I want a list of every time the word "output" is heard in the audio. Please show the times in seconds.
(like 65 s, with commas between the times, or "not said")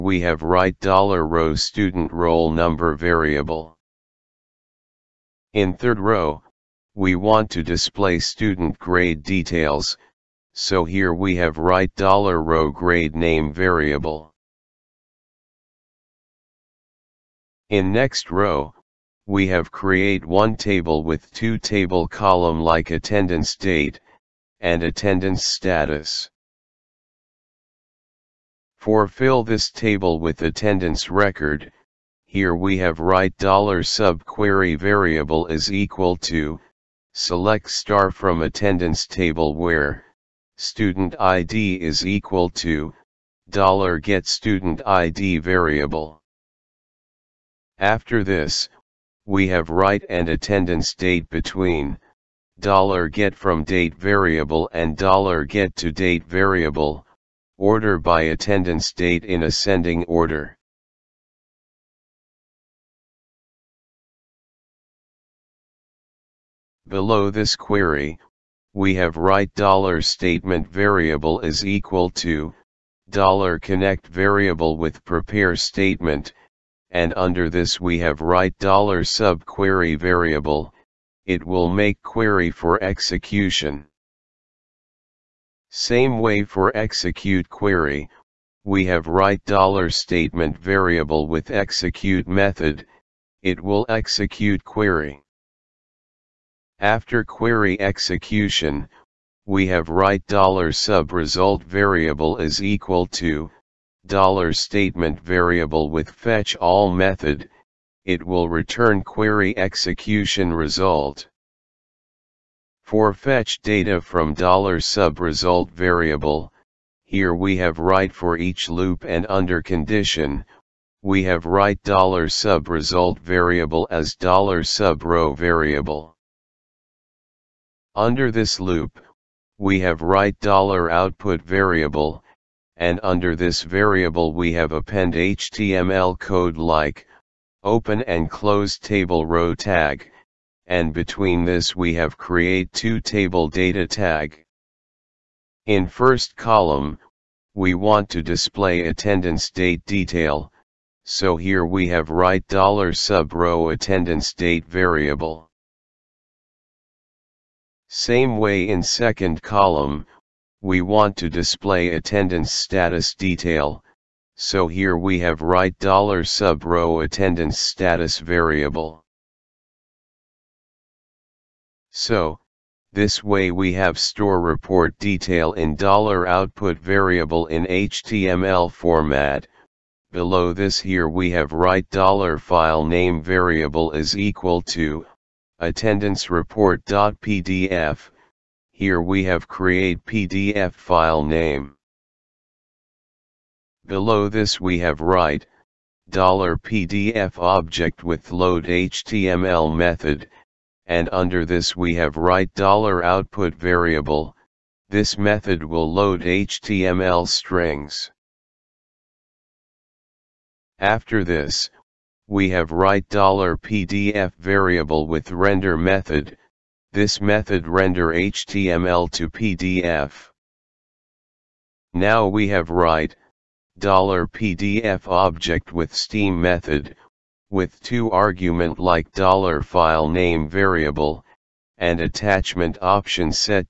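130 s, 176 s, 202 s.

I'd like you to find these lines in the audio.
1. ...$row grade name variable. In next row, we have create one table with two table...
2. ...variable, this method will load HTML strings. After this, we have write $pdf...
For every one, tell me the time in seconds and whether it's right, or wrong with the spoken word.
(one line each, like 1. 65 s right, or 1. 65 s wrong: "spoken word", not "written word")
1. 12 s right
2. 203 s right.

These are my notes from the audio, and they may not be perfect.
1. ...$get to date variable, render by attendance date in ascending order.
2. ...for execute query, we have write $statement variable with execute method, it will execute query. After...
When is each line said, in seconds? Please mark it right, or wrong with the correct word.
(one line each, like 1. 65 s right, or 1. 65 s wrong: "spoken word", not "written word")
1. 55 s wrong: "order", not "render"
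2. 86 s right.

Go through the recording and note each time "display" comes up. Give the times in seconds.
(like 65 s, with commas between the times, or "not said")
7 s, 148 s, 161 s.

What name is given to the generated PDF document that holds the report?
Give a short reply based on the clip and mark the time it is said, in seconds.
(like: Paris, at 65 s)
attendance report.pdf, at 185 s.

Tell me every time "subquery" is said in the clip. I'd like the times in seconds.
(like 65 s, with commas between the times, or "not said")
33 s, 78 s.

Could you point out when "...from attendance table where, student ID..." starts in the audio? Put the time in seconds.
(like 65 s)
38 s.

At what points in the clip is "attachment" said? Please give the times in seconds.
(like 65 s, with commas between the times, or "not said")
232 s.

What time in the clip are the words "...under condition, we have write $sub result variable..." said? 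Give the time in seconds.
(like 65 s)
119 s.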